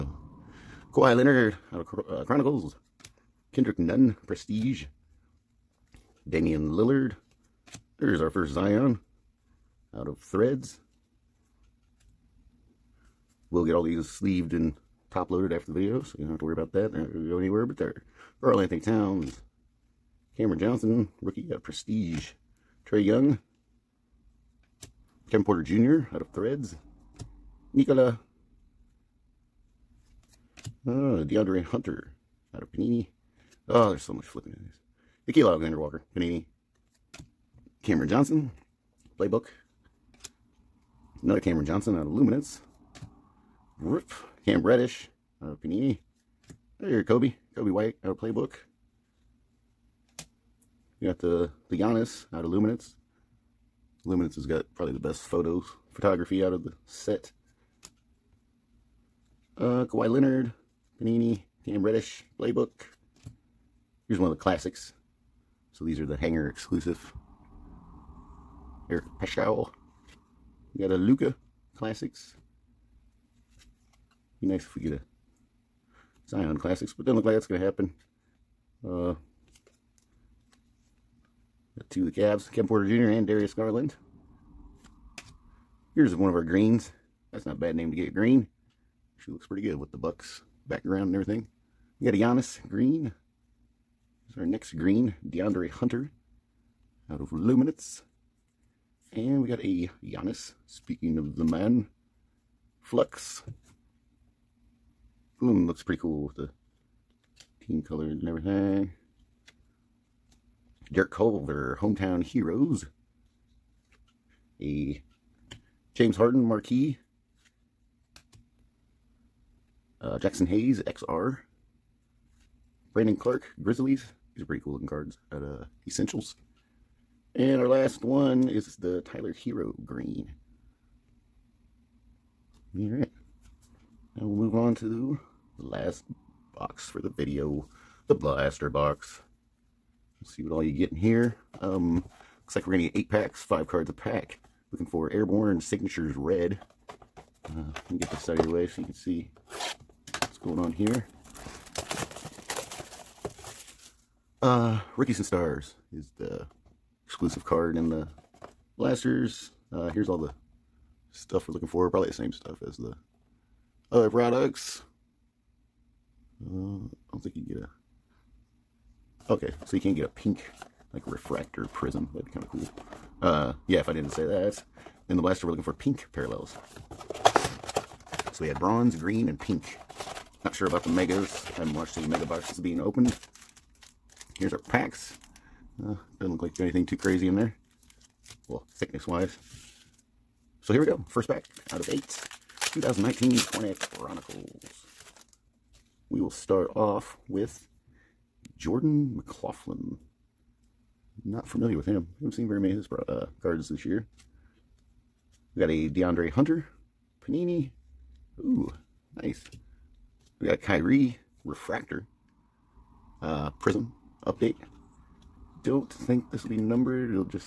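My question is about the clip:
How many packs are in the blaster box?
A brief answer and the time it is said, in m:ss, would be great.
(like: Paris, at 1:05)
8, at 2:22.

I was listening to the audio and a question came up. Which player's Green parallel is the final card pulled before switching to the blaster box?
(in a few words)
Tyler Herro.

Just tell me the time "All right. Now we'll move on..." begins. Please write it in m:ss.
2:12.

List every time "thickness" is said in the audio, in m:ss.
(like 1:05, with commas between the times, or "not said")
3:08.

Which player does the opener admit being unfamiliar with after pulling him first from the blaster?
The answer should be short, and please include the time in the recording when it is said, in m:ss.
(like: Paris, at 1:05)
Jordan McLaughlin, at 3:18.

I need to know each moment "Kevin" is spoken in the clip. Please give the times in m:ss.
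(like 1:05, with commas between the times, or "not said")
0:25, 1:22.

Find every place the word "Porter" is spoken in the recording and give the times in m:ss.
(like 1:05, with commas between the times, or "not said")
0:25, 1:22.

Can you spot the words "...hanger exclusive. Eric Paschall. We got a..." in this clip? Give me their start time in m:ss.
1:06.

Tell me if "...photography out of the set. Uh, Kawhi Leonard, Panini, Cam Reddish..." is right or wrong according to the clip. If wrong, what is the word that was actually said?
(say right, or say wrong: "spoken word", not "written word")
right.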